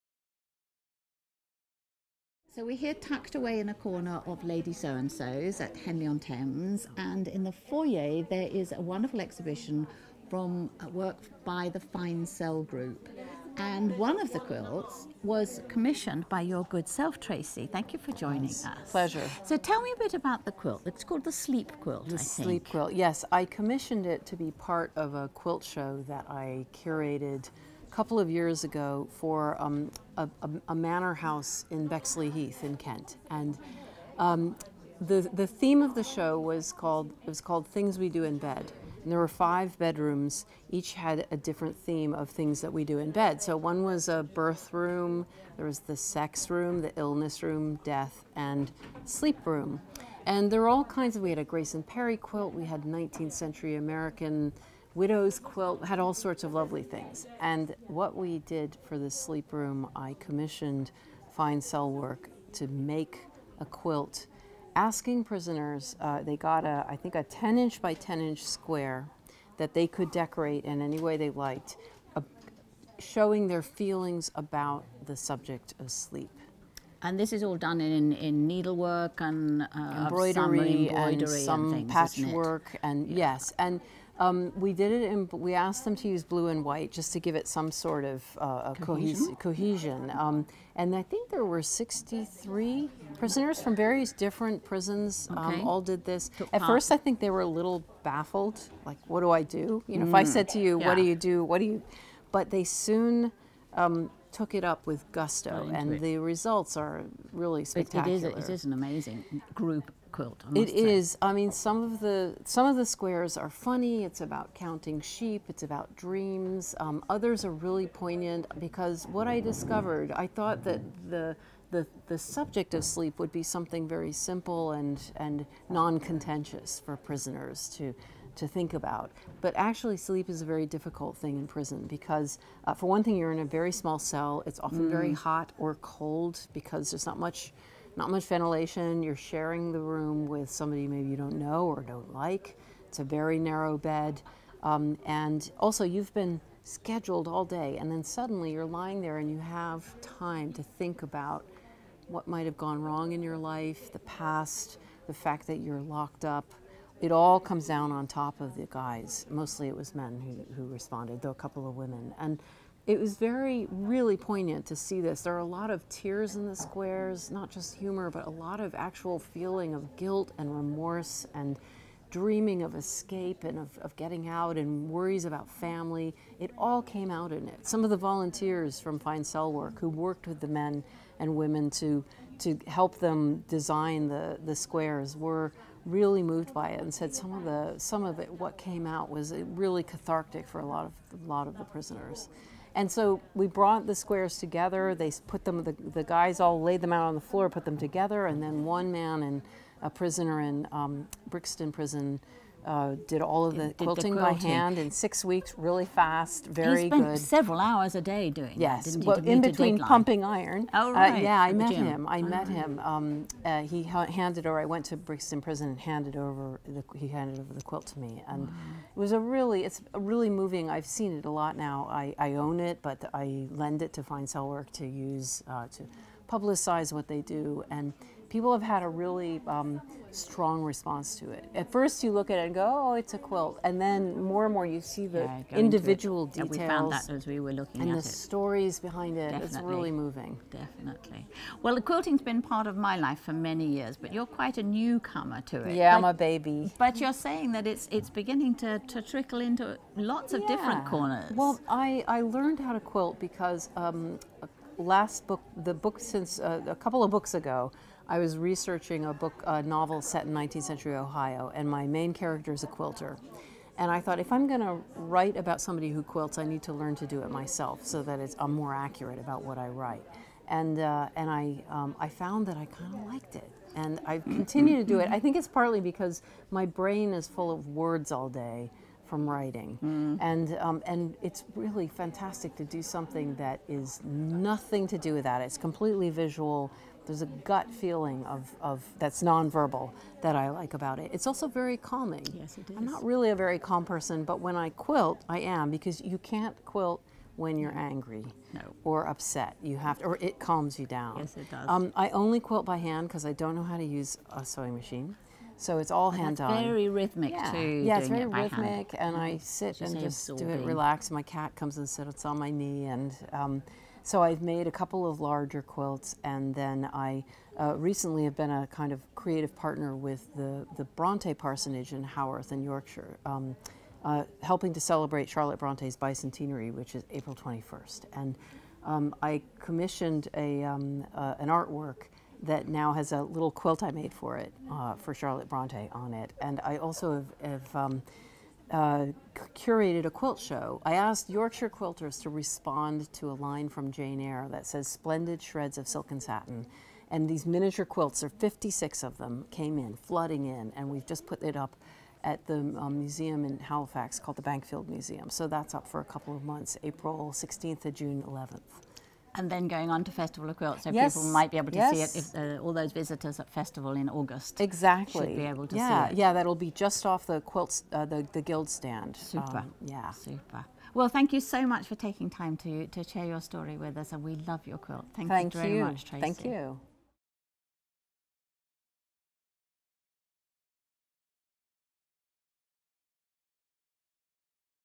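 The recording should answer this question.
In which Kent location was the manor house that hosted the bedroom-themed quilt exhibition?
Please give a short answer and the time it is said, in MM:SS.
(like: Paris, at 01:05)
Bexley Heath, at 00:31.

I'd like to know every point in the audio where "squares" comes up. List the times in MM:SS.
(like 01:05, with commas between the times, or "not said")
01:08, 01:52, 02:46, 03:04, 03:13.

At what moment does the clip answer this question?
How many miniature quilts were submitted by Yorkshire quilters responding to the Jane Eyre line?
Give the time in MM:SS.
05:48.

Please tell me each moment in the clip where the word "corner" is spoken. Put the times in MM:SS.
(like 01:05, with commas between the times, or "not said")
00:03, 04:10.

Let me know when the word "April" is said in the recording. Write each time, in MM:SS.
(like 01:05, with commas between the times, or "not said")
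05:27, 05:56.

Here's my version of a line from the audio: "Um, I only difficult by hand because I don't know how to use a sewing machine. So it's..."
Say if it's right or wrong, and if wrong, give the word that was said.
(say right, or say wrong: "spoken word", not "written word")
wrong: "quilt", not "difficult".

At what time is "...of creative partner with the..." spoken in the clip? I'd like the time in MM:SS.
05:18.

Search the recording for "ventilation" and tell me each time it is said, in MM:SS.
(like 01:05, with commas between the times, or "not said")
02:18.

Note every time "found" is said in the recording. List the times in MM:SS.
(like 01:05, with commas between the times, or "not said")
03:56, 04:32.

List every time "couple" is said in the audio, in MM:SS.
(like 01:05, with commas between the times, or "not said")
00:27, 02:41, 04:16, 05:14, 05:56.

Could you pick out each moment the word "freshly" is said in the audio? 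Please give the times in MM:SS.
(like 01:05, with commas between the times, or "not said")
not said.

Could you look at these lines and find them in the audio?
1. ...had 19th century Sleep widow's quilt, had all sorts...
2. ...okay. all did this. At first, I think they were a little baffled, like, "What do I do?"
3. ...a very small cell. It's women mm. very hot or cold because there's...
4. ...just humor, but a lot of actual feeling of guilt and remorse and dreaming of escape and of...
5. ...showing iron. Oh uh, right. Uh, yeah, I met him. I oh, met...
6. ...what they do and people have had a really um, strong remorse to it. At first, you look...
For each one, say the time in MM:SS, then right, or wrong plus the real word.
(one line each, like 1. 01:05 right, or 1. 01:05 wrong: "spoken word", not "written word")
1. 00:52 wrong: "American", not "Sleep"
2. 01:35 right
3. 02:13 wrong: "often", not "women"
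4. 02:47 right
5. 03:29 wrong: "pumping", not "showing"
6. 03:46 wrong: "response", not "remorse".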